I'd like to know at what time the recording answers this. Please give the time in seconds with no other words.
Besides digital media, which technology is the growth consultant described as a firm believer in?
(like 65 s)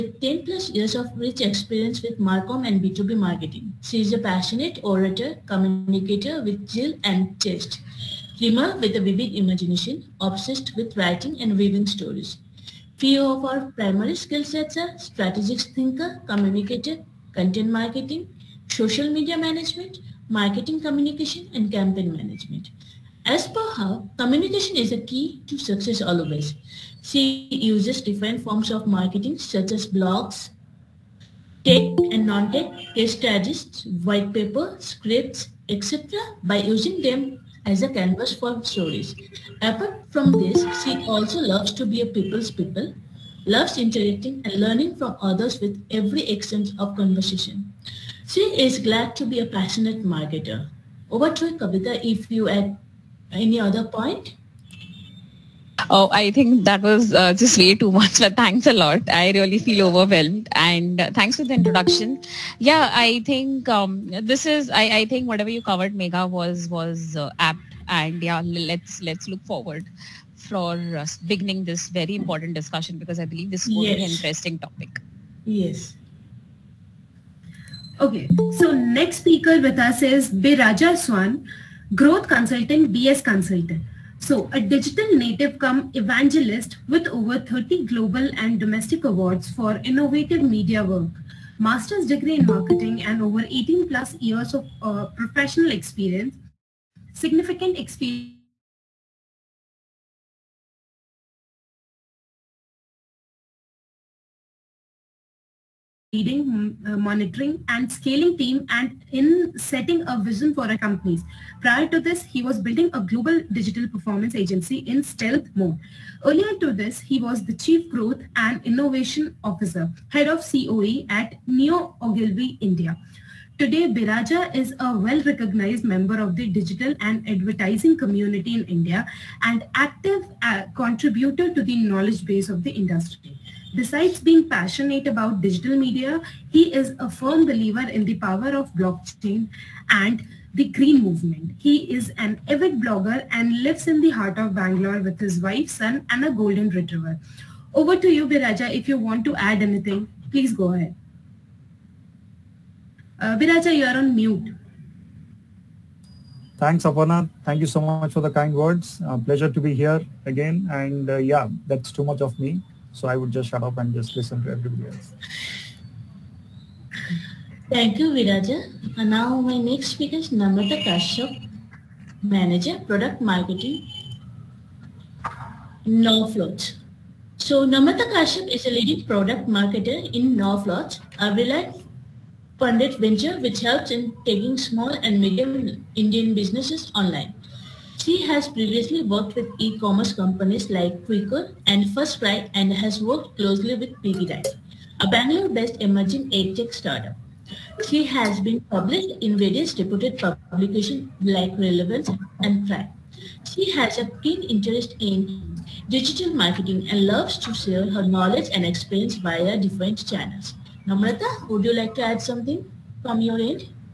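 138 s.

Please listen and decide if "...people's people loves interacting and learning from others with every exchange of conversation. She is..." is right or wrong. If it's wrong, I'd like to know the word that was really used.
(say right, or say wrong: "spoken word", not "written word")
right.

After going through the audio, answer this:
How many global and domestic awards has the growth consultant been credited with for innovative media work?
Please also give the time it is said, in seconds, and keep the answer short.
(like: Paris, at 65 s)
30, at 87 s.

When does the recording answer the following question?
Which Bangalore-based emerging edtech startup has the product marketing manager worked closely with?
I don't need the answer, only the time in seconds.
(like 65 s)
194 s.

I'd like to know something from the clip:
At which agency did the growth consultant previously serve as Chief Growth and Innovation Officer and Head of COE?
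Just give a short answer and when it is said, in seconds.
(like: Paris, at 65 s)
Neo Ogilvy India, at 121 s.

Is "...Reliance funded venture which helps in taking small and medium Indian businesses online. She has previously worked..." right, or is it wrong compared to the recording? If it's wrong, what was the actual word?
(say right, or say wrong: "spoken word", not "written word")
right.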